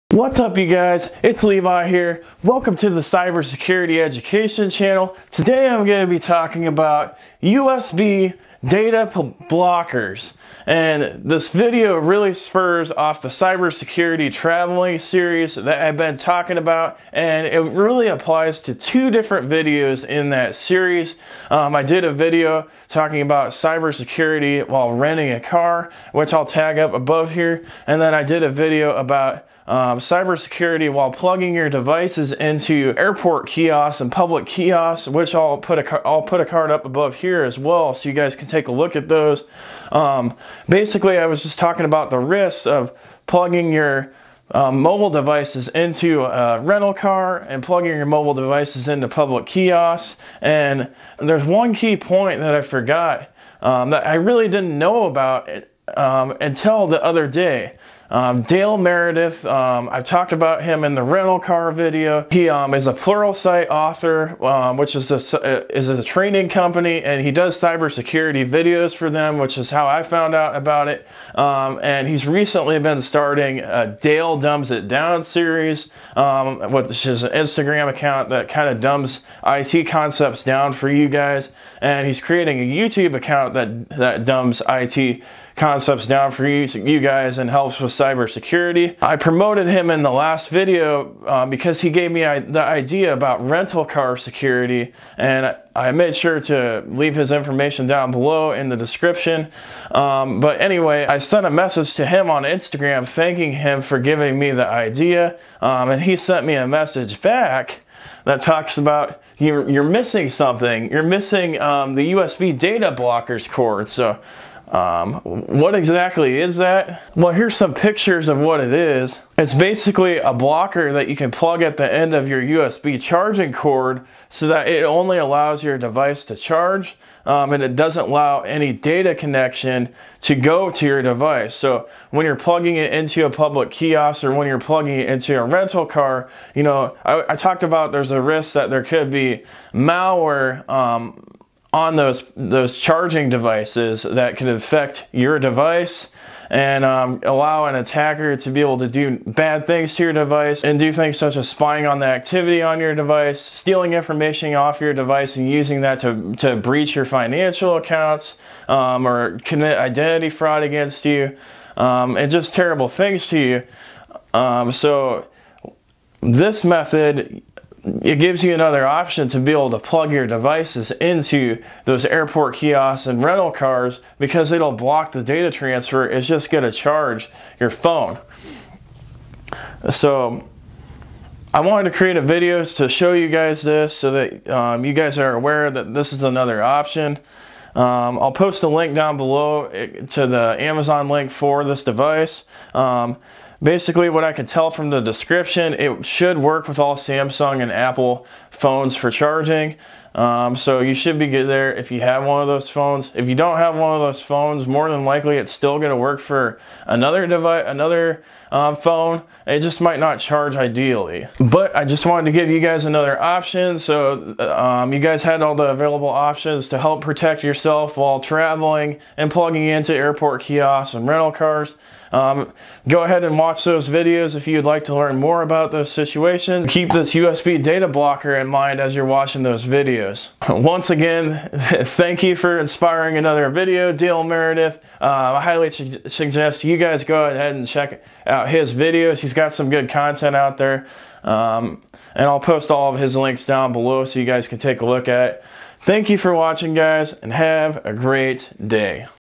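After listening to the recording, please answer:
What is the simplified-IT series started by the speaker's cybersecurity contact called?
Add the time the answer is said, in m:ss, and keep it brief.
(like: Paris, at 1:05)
Dale Dumbs It Down, at 1:14.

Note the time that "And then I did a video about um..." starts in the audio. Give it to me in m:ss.
0:27.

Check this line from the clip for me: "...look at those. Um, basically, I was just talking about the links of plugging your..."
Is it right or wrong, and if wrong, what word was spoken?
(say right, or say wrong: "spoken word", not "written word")
wrong: "risks", not "links".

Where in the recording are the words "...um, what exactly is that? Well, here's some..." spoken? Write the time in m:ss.
1:54.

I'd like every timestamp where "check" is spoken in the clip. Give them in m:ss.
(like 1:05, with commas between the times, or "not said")
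3:57.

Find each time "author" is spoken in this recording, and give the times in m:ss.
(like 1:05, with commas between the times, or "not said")
1:03.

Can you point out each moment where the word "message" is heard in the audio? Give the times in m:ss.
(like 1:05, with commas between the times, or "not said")
1:41, 1:46.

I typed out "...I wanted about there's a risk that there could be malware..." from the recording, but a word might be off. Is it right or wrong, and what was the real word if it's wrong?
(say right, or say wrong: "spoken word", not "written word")
wrong: "talked", not "wanted".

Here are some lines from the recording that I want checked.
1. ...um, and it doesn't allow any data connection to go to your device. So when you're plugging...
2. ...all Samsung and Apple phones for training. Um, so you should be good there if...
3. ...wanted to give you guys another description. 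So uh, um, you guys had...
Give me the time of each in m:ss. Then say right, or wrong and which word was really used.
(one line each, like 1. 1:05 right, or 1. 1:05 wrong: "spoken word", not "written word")
1. 2:07 right
2. 3:16 wrong: "charging", not "training"
3. 3:32 wrong: "option", not "description".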